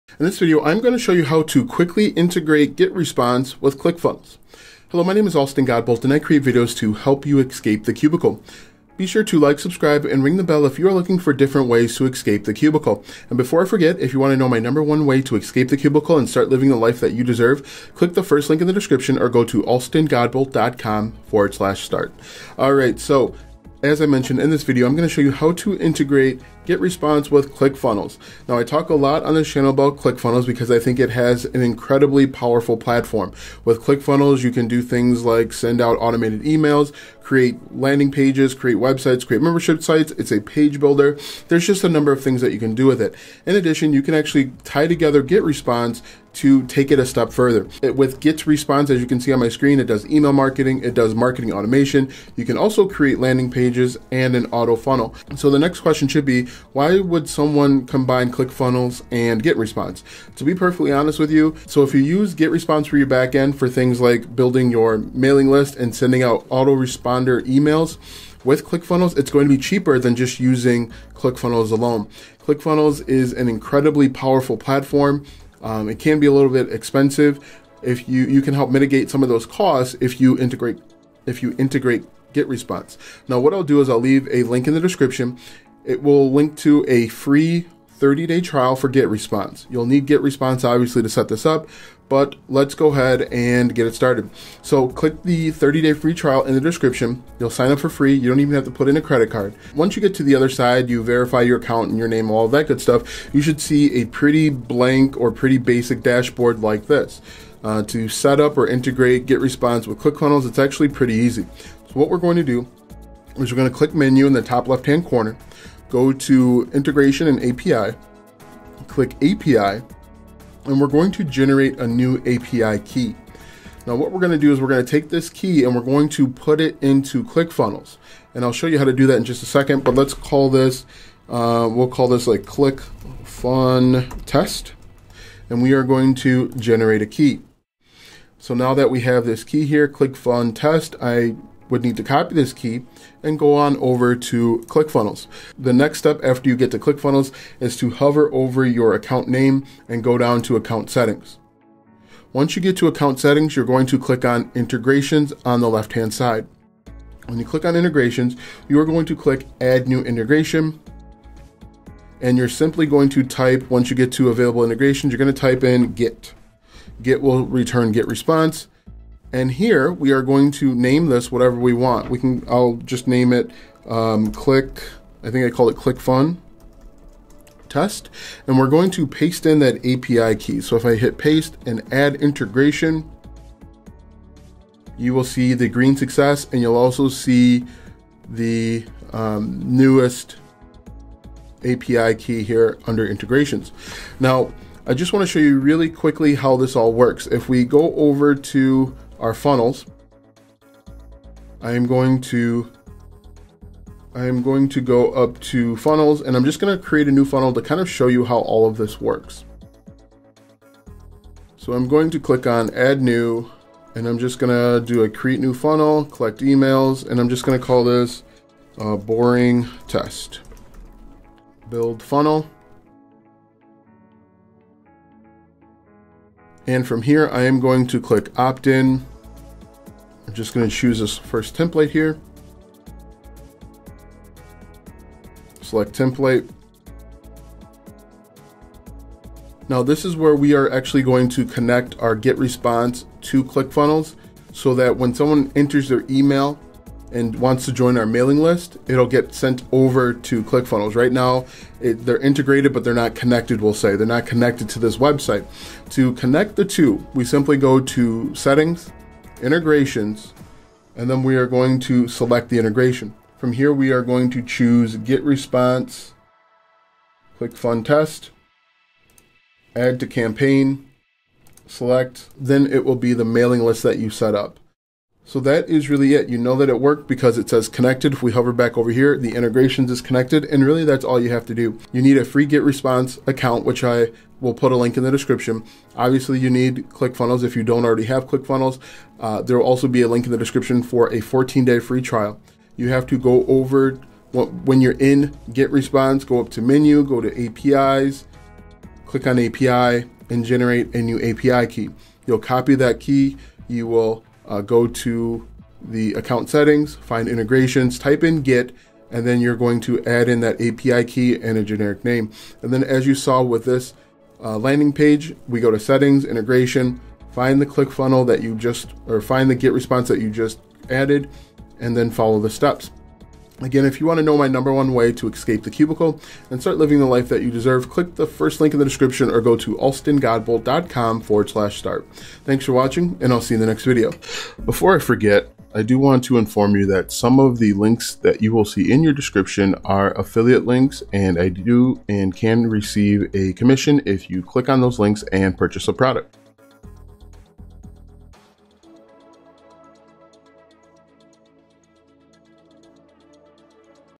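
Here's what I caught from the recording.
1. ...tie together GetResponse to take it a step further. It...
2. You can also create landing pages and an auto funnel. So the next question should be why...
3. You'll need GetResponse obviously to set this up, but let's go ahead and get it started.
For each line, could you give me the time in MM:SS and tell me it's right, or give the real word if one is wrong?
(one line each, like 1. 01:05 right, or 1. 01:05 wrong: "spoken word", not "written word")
1. 00:44 right
2. 00:52 right
3. 01:29 right.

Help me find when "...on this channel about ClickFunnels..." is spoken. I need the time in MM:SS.
00:29.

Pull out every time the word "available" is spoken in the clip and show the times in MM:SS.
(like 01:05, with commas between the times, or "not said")
02:44.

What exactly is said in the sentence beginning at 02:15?
And we are going to generate a key.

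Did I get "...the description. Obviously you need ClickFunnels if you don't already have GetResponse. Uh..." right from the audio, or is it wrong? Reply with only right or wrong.
wrong.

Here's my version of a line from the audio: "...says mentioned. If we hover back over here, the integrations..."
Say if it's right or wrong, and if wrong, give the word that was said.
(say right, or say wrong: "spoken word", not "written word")
wrong: "connected", not "mentioned".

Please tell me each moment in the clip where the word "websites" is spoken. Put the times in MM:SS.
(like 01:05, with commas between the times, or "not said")
00:38, 04:14.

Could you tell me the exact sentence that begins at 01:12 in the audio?
ClickFunnels is an incredibly powerful platform.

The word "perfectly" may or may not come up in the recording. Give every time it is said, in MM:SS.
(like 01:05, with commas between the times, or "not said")
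01:00.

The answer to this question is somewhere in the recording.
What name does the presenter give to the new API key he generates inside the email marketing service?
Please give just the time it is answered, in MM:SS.
02:12.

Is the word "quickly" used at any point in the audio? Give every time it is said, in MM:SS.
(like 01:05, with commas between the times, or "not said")
00:01, 03:15.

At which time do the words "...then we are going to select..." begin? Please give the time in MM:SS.
04:21.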